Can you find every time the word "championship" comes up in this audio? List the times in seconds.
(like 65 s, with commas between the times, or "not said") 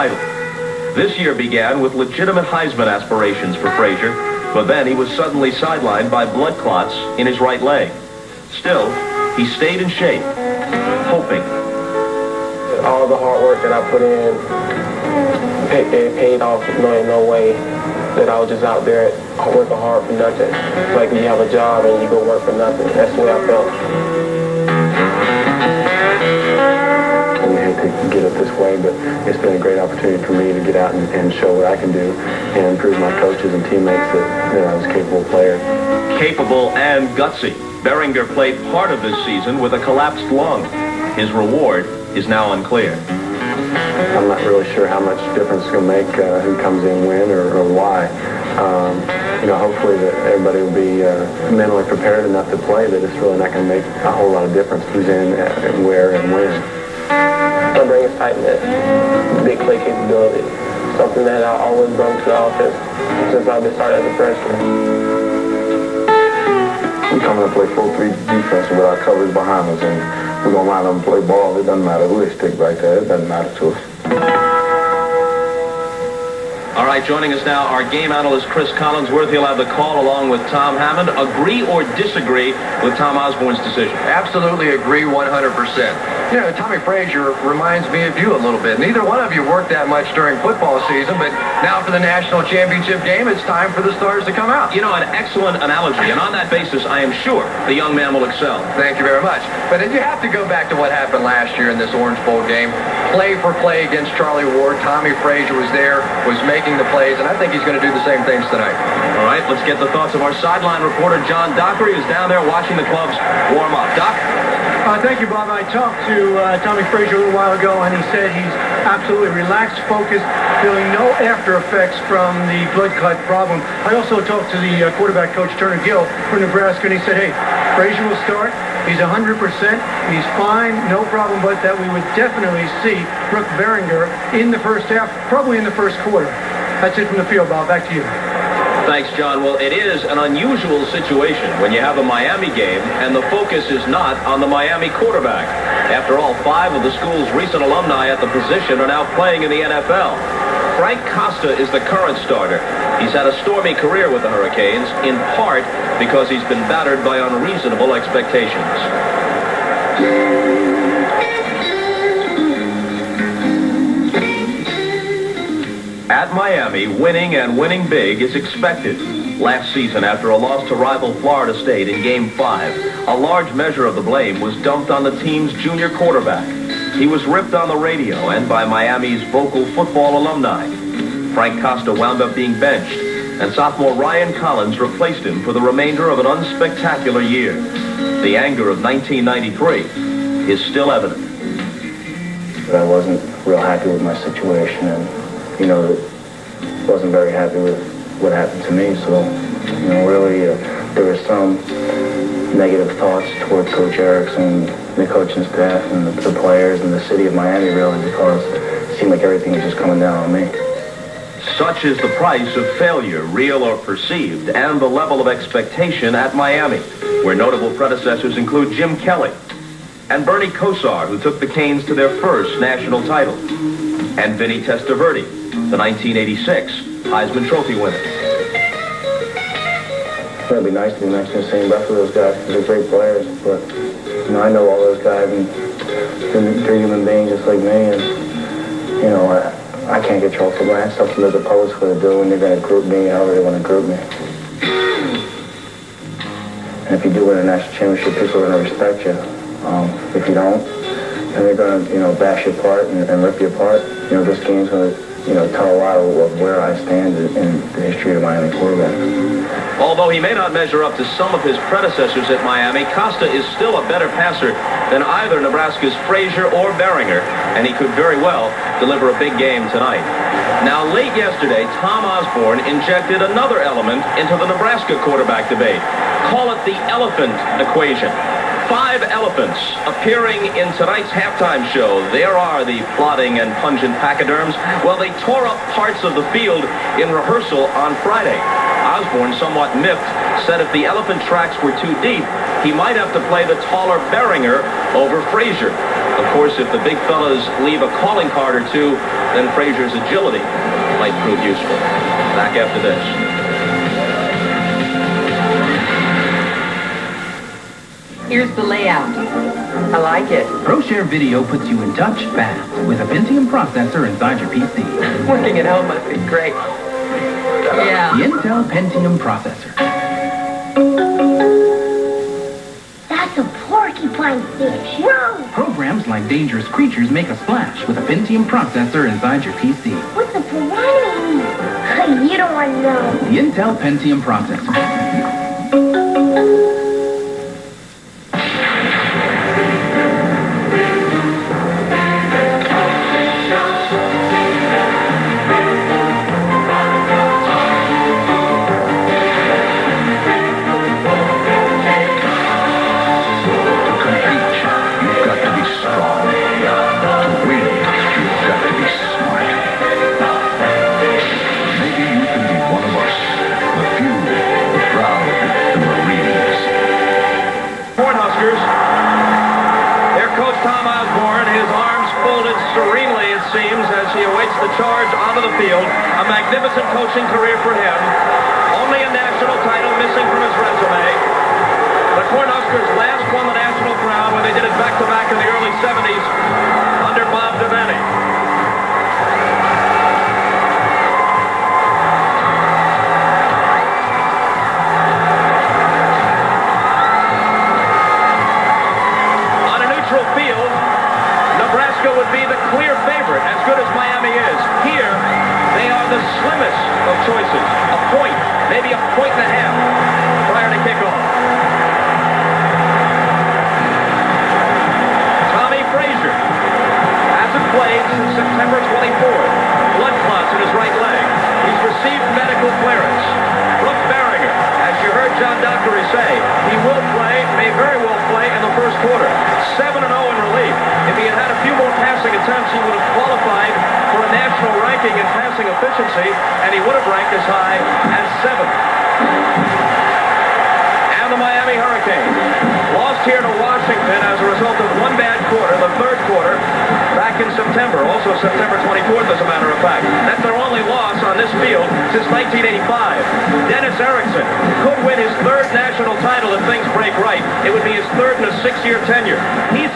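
92 s, 247 s.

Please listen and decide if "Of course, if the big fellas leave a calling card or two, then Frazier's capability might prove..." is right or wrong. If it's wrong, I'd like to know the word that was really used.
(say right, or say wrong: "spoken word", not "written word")
wrong: "agility", not "capability".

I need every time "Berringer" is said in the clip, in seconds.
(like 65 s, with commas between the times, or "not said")
37 s, 133 s, 266 s, 294 s.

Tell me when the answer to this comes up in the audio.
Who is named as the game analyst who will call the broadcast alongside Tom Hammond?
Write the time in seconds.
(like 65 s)
78 s.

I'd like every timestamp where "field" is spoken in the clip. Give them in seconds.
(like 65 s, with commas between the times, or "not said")
137 s, 286 s, 451 s.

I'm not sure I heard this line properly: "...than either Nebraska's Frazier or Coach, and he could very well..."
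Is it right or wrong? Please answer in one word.
wrong.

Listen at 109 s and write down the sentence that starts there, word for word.
All right, let's get the thoughts of our sideline reporter, John Dockery, who's down there watching the clubs warm up.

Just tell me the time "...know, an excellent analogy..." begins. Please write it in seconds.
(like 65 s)
94 s.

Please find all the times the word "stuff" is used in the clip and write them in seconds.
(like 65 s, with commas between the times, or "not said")
not said.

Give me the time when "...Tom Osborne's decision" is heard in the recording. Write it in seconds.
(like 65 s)
82 s.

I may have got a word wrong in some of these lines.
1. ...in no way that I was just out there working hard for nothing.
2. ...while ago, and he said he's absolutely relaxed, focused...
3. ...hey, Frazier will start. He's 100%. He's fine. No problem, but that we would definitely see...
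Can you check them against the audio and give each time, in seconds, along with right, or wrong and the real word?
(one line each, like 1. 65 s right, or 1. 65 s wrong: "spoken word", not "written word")
1. 16 s right
2. 117 s right
3. 127 s right.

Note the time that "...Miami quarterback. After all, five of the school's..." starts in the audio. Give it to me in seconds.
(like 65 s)
144 s.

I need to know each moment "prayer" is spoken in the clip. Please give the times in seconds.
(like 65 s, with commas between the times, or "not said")
not said.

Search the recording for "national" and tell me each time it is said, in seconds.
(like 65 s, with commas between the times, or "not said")
91 s, 222 s, 247 s, 434 s, 455 s.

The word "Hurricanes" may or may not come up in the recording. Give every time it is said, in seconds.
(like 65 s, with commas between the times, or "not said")
154 s, 441 s.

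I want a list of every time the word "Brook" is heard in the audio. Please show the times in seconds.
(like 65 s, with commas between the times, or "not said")
133 s.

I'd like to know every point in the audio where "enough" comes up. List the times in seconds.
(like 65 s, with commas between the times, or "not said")
52 s.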